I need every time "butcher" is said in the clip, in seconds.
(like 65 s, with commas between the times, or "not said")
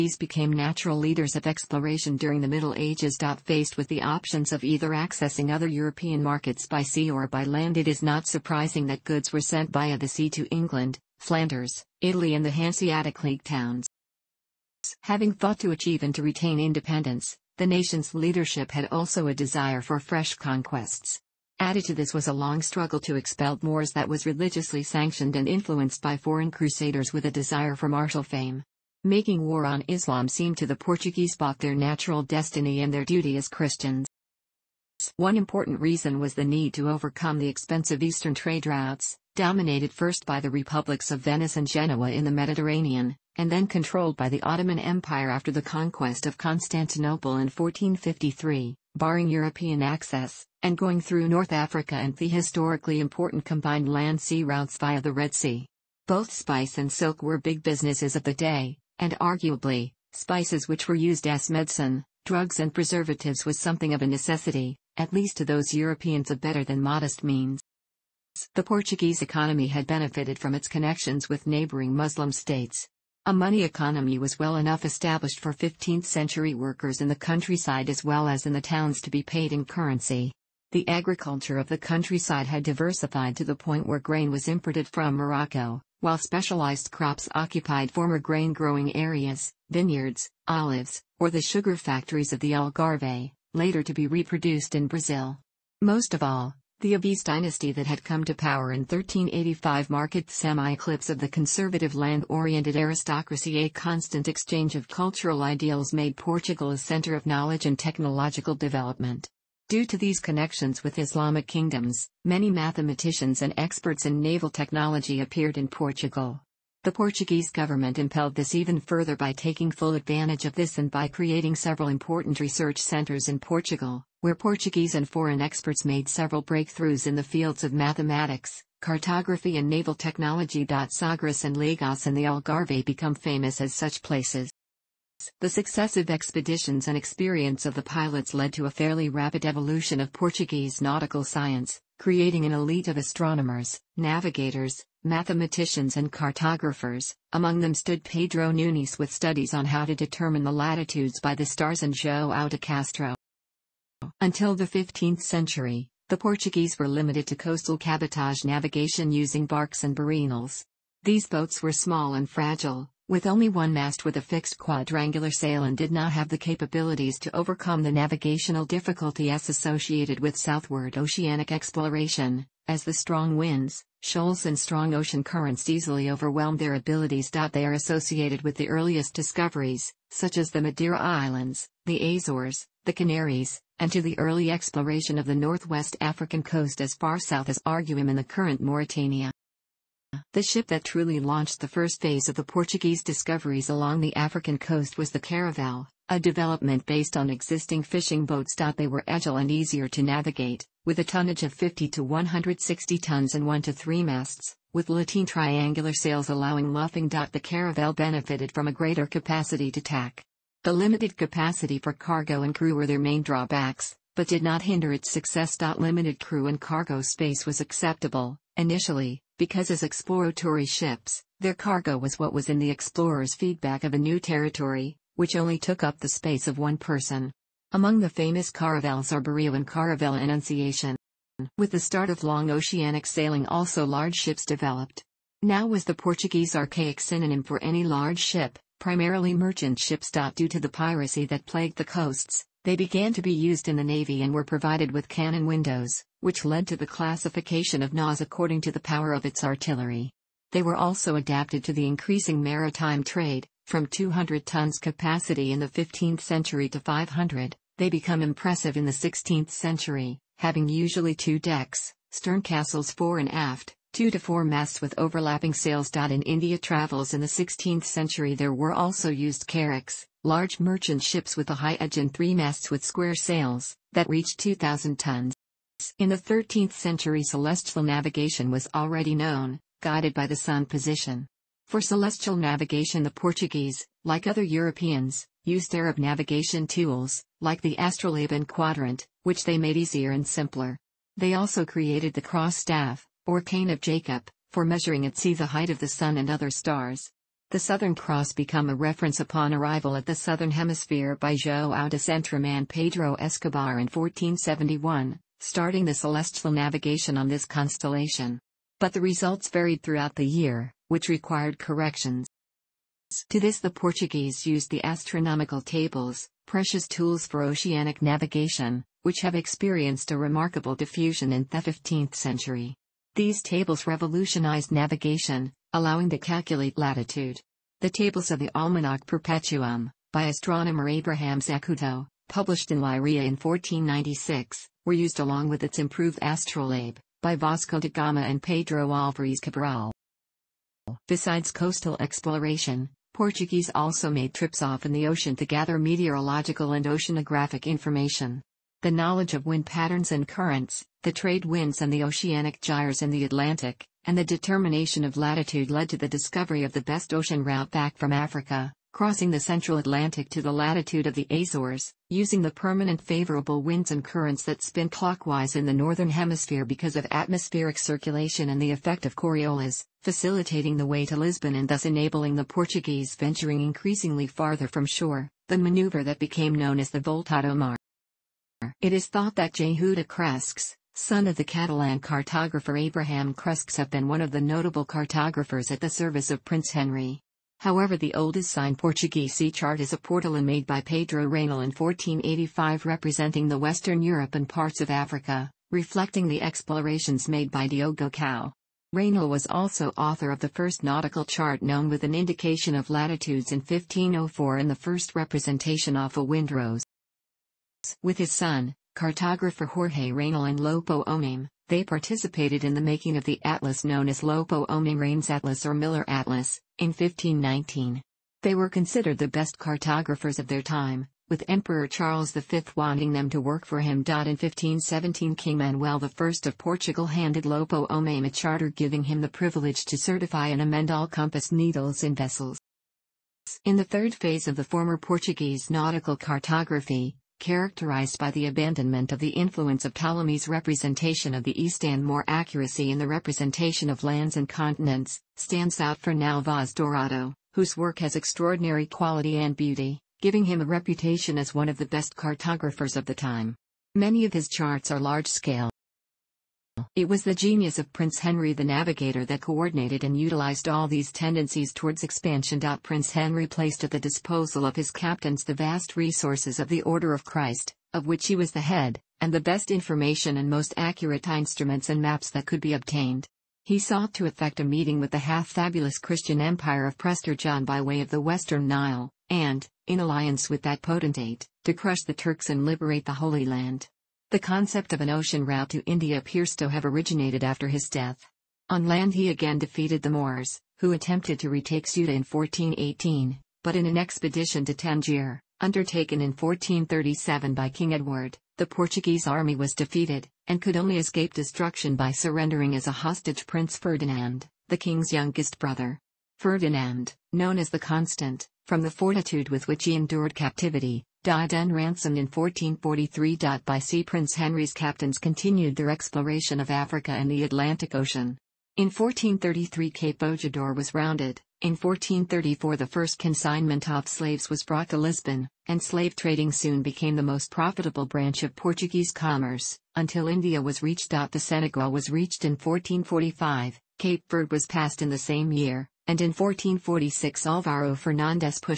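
not said.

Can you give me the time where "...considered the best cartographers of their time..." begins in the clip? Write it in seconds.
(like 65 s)
418 s.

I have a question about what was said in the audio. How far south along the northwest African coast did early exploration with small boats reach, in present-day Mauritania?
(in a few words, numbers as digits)
Arguim.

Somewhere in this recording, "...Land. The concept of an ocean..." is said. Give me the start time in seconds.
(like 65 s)
483 s.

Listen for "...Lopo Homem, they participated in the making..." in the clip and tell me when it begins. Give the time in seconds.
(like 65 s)
410 s.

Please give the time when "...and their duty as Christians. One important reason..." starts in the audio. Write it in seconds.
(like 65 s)
32 s.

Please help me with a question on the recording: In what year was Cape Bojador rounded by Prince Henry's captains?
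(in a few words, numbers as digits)
1433.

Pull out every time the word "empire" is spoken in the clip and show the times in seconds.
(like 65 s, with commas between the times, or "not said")
44 s, 476 s.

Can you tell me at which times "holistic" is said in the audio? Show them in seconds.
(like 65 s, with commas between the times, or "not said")
not said.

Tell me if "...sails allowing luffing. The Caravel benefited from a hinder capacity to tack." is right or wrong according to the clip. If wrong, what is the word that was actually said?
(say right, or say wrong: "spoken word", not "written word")
wrong: "greater", not "hinder".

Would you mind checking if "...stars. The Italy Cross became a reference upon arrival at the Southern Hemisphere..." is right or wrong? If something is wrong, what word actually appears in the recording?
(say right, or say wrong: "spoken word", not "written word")
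wrong: "Southern", not "Italy".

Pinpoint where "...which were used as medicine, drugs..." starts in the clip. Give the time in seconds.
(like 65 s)
60 s.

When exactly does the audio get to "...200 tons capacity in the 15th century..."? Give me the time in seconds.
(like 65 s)
253 s.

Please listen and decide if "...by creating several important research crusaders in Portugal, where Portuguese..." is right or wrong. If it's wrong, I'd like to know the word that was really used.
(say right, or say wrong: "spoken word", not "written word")
wrong: "centers", not "crusaders".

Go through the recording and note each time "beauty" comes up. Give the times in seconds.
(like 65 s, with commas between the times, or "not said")
449 s.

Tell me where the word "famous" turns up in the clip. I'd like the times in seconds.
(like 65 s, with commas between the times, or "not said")
133 s, 228 s.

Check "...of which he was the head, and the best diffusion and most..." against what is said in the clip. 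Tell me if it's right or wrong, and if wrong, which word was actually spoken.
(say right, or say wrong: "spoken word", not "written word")
wrong: "information", not "diffusion".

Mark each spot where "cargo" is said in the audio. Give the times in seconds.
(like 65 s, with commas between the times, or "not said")
211 s, 216 s, 221 s.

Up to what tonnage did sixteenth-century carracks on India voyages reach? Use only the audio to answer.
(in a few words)
2,000 tons.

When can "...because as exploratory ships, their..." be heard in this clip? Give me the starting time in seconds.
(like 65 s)
219 s.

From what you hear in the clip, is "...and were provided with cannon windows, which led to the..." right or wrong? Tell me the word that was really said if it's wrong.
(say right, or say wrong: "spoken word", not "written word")
right.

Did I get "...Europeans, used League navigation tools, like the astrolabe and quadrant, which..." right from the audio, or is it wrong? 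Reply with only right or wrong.
wrong.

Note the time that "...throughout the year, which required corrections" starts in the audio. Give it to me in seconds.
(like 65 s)
309 s.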